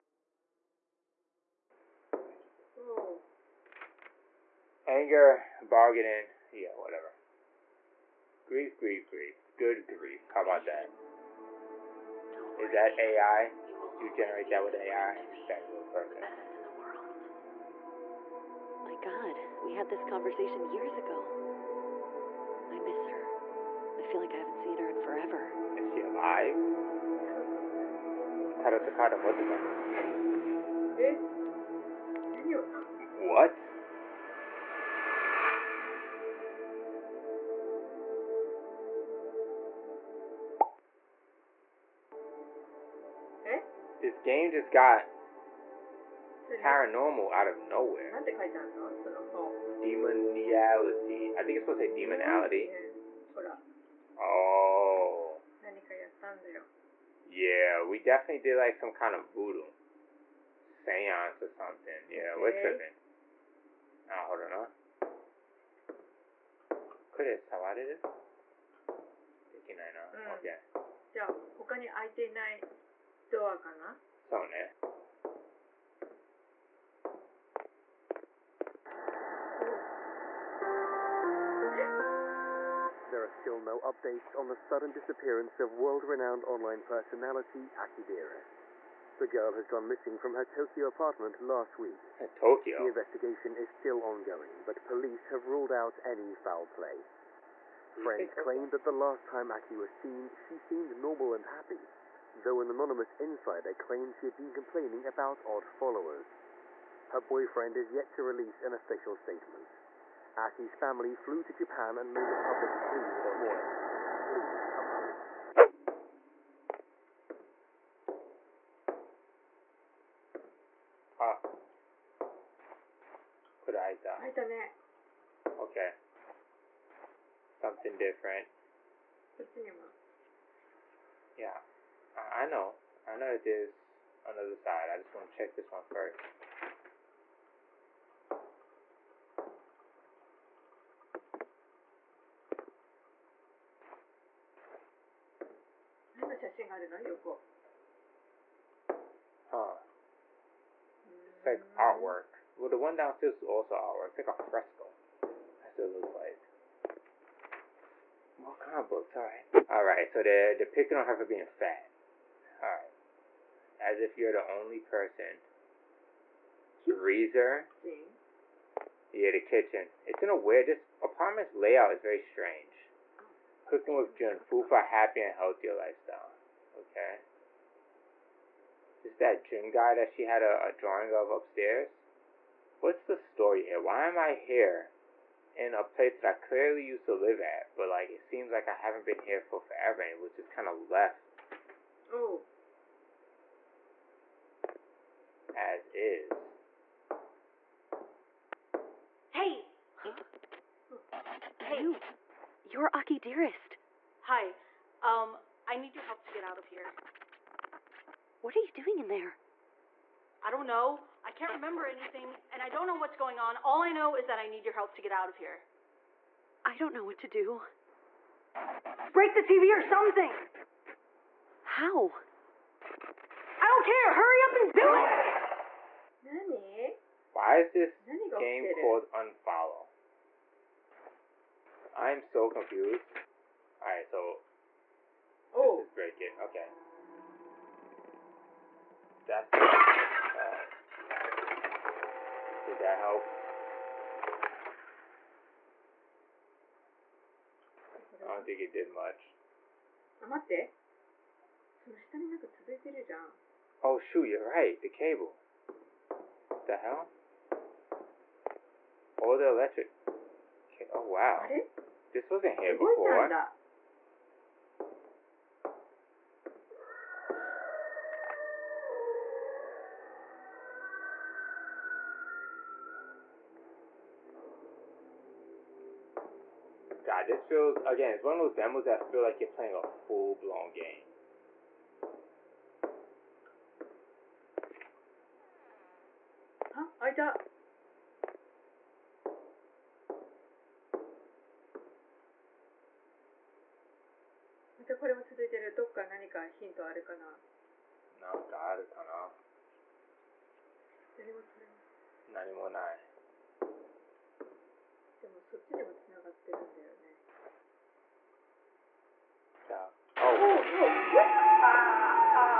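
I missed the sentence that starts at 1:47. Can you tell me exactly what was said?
Her boyfriend is yet to release an official statement, as his family flew to Japan and made a public plea this morning.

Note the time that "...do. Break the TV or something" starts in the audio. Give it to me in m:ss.
3:37.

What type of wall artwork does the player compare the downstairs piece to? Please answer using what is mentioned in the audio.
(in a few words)
A fresco.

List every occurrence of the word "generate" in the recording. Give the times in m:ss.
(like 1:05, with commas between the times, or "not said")
0:14.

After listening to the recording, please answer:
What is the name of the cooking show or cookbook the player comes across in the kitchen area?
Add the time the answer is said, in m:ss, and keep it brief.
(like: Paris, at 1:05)
Cooking with Jun, at 2:53.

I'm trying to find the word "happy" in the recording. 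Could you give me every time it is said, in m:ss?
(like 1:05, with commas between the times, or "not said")
1:41, 2:54.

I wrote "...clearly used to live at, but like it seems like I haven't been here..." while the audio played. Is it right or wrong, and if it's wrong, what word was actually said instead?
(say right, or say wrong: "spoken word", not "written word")
right.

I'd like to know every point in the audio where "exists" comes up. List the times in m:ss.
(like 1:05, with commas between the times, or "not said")
not said.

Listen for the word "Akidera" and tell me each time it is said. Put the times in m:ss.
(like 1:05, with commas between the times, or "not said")
1:27.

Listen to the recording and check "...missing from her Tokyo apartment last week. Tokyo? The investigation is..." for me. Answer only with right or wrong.
right.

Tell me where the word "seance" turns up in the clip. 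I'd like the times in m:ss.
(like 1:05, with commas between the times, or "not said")
1:00.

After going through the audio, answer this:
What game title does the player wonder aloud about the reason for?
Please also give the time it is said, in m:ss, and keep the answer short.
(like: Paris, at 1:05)
Unfollow, at 3:49.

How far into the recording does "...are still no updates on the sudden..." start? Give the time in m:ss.
1:23.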